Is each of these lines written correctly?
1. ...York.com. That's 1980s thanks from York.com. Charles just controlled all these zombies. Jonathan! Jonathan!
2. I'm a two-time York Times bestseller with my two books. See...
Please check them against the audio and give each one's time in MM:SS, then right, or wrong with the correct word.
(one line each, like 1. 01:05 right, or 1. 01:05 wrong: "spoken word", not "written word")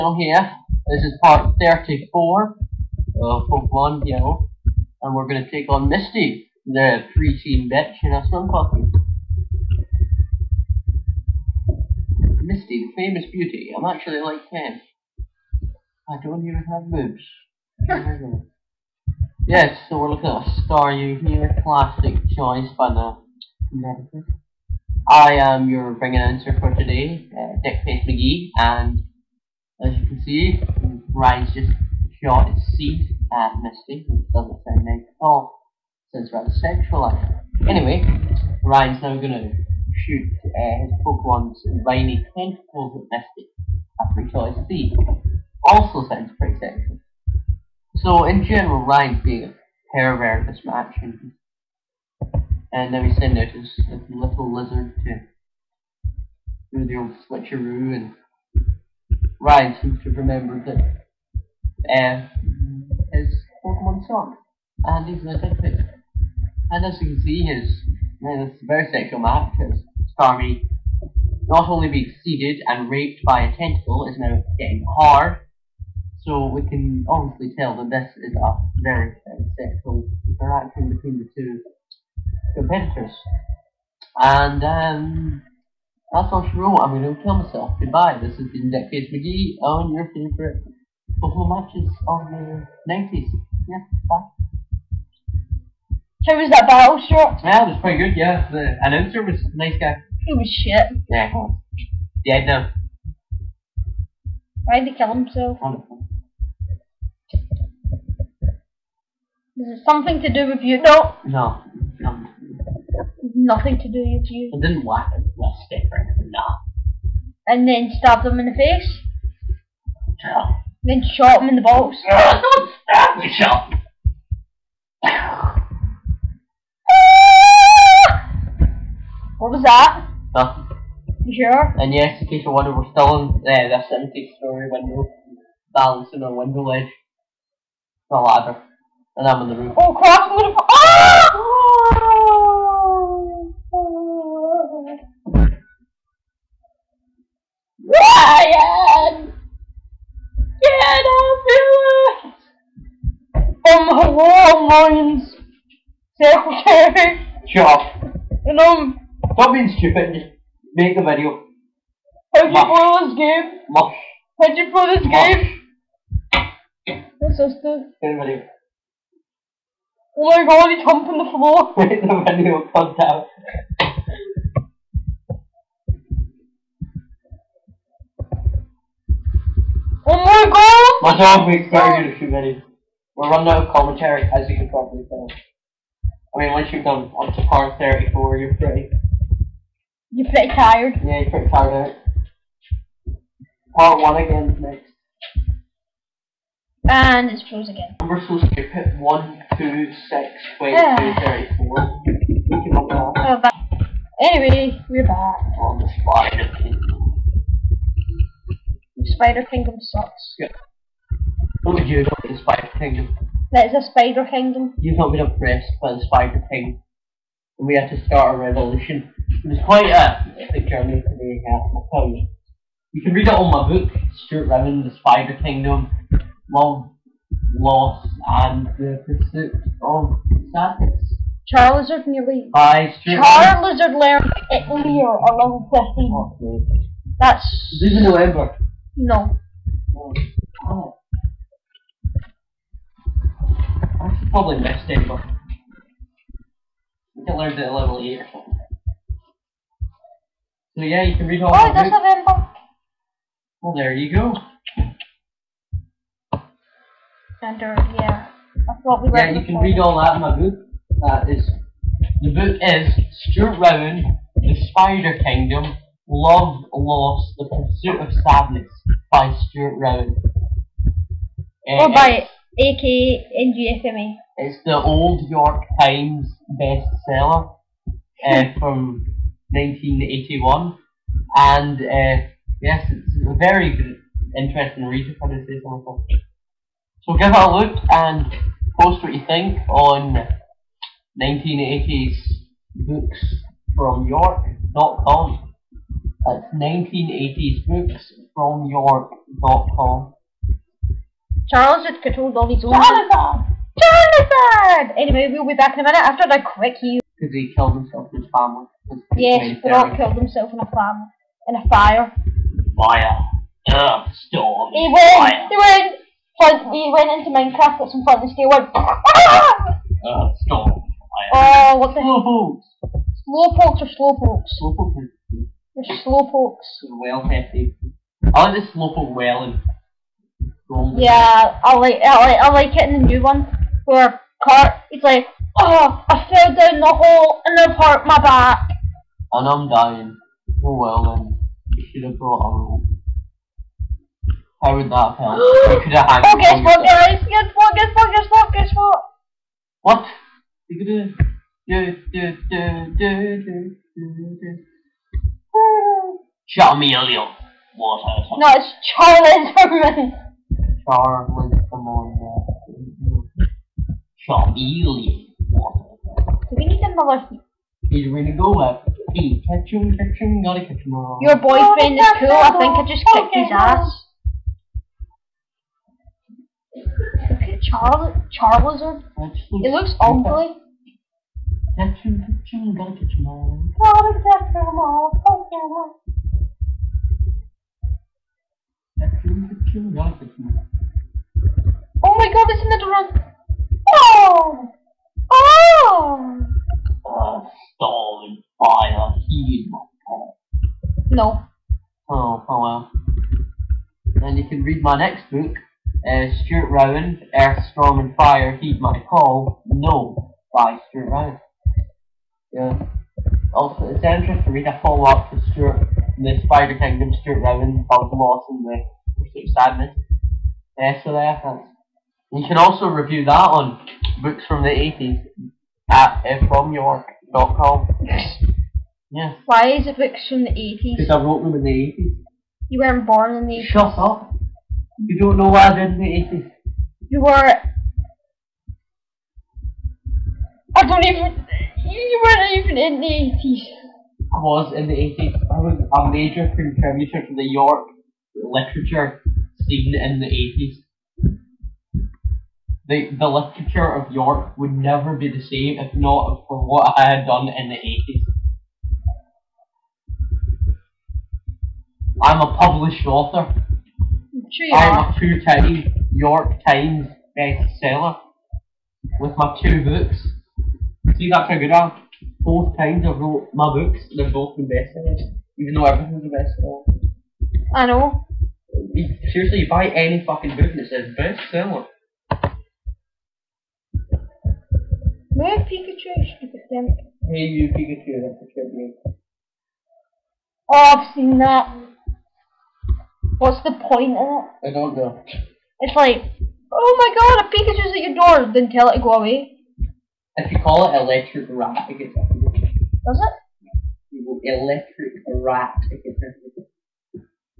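1. 04:54 wrong: "books", not "thanks"
2. 07:44 right.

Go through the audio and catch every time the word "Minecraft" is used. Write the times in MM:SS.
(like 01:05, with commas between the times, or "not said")
05:17.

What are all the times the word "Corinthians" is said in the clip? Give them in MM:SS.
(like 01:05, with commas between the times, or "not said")
not said.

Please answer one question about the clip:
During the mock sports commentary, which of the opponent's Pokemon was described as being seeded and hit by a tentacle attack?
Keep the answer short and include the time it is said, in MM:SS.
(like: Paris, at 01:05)
Starmie, at 01:10.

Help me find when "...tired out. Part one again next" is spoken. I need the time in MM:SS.
03:11.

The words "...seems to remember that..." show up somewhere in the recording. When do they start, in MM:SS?
00:59.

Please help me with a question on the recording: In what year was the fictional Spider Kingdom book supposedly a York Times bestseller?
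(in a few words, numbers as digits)
1981.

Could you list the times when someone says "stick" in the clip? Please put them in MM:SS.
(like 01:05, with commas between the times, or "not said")
01:55.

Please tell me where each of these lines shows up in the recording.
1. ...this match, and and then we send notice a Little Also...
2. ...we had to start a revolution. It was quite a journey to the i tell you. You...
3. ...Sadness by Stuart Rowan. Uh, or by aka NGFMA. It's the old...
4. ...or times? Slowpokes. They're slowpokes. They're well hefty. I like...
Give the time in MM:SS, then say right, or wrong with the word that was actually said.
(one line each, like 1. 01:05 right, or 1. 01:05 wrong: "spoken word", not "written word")
1. 00:50 wrong: "Lizard", not "Also"
2. 03:37 right
3. 04:28 right
4. 05:23 wrong: "slowpokes", not "times".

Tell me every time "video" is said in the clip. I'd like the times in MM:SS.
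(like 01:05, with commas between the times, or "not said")
02:41, 02:48, 02:52.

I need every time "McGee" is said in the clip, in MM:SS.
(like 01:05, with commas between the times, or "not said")
00:28, 01:29.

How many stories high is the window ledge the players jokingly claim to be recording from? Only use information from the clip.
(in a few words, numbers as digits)
70.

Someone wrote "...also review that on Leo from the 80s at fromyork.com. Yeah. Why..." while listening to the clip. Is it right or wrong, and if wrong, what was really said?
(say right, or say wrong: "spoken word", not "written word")
wrong: "Books", not "Leo".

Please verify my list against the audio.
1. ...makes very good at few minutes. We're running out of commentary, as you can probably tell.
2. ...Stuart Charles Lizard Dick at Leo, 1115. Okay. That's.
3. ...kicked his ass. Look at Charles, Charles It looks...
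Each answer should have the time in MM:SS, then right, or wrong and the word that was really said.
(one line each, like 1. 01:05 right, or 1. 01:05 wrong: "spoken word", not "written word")
1. 03:01 right
2. 03:52 wrong: "Lair", not "Dick"
3. 06:13 right.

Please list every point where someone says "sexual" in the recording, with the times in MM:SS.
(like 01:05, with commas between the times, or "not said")
00:36, 00:46, 01:08, 01:19.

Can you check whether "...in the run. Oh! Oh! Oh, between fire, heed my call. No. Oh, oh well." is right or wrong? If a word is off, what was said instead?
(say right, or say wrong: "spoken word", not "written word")
wrong: "stolen", not "between".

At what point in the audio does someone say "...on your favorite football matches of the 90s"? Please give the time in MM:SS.
01:29.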